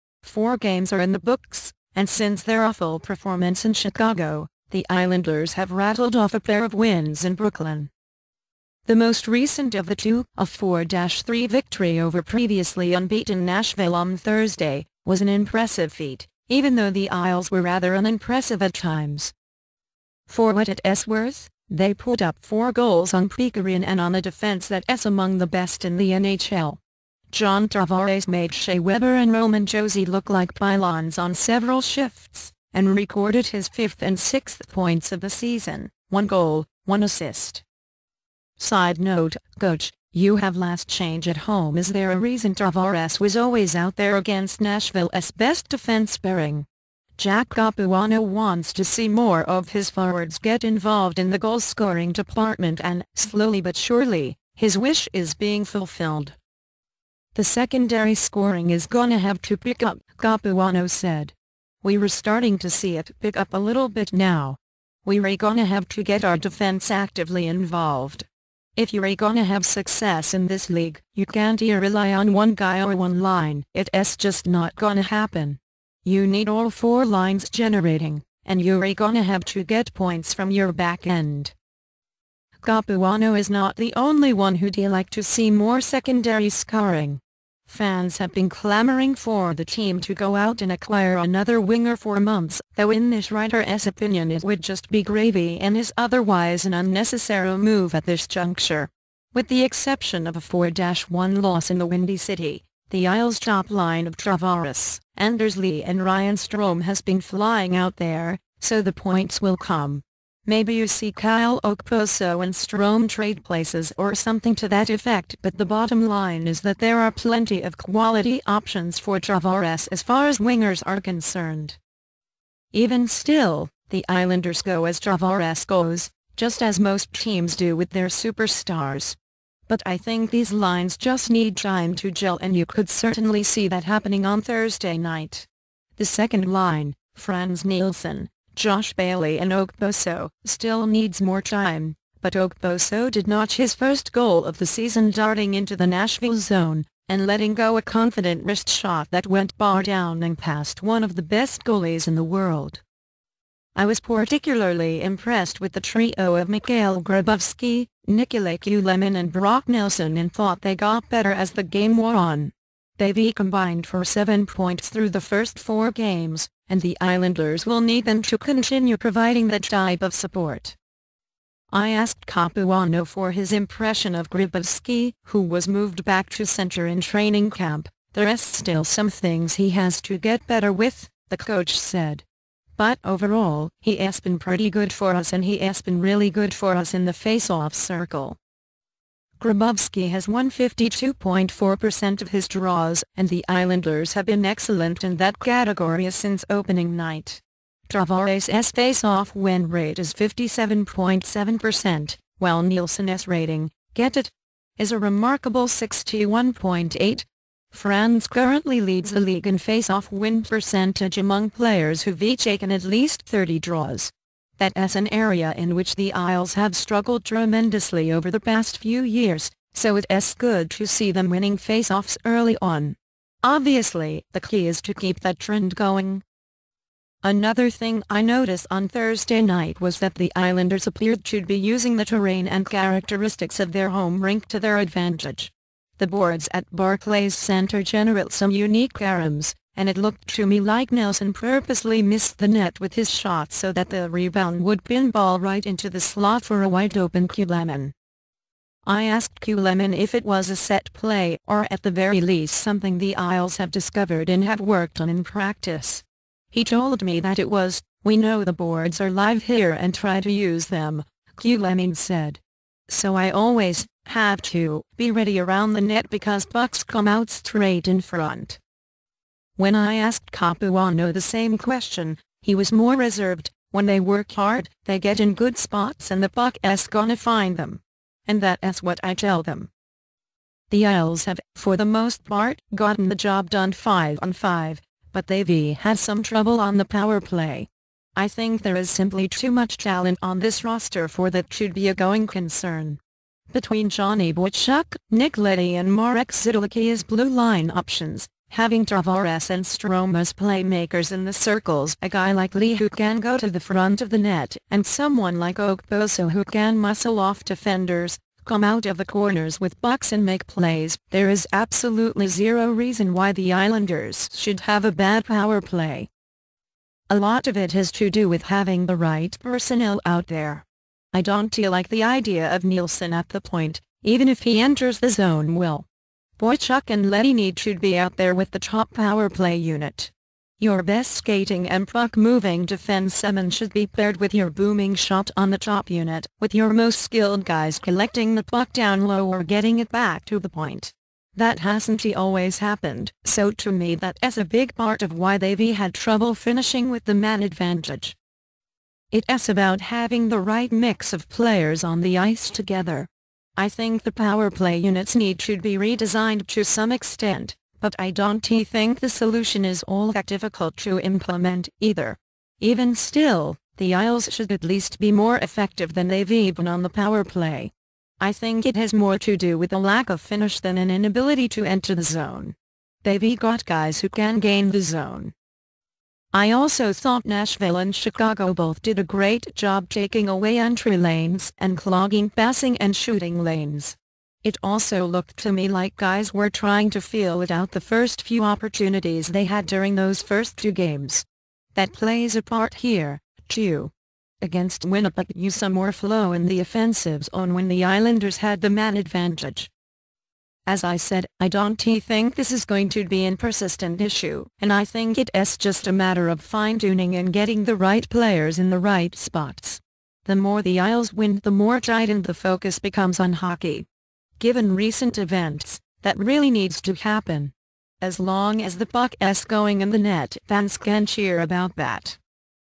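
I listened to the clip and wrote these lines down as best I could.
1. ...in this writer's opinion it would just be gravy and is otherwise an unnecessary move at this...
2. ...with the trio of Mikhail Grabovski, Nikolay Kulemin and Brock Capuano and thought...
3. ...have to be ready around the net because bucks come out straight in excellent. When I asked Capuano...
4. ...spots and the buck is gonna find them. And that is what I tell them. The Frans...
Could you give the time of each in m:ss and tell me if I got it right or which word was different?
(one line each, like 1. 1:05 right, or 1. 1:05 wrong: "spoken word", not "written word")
1. 1:32 right
2. 2:35 wrong: "Nelson", not "Capuano"
3. 4:24 wrong: "front", not "excellent"
4. 4:35 wrong: "Isles", not "Frans".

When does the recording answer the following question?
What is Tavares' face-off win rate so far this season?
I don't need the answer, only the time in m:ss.
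3:20.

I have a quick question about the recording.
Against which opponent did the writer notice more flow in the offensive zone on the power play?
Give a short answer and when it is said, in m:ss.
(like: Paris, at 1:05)
Winnipeg, at 6:34.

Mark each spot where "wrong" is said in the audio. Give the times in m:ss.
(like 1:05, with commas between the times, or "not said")
not said.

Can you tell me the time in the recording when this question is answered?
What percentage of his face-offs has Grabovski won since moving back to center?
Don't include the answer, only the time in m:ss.
3:10.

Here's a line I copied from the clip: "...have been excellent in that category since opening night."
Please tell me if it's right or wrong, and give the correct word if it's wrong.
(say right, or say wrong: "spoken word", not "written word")
right.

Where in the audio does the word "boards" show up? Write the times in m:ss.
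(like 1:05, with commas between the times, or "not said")
3:56, 4:18.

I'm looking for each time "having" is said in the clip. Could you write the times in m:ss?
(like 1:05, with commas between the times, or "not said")
4:58, 5:18, 5:49.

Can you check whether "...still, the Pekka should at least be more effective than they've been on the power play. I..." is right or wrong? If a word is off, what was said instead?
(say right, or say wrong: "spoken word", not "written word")
wrong: "Isles", not "Pekka".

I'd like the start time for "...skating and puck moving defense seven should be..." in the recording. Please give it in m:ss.
5:31.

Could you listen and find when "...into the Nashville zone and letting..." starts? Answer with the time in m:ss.
2:25.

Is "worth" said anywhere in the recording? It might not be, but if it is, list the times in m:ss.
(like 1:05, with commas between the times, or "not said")
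0:21.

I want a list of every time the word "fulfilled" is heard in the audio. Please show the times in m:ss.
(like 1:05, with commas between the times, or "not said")
0:55.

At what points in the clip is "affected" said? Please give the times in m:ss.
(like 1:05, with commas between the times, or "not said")
not said.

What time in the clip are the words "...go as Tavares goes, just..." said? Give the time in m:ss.
2:04.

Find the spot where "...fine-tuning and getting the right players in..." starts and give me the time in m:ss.
6:46.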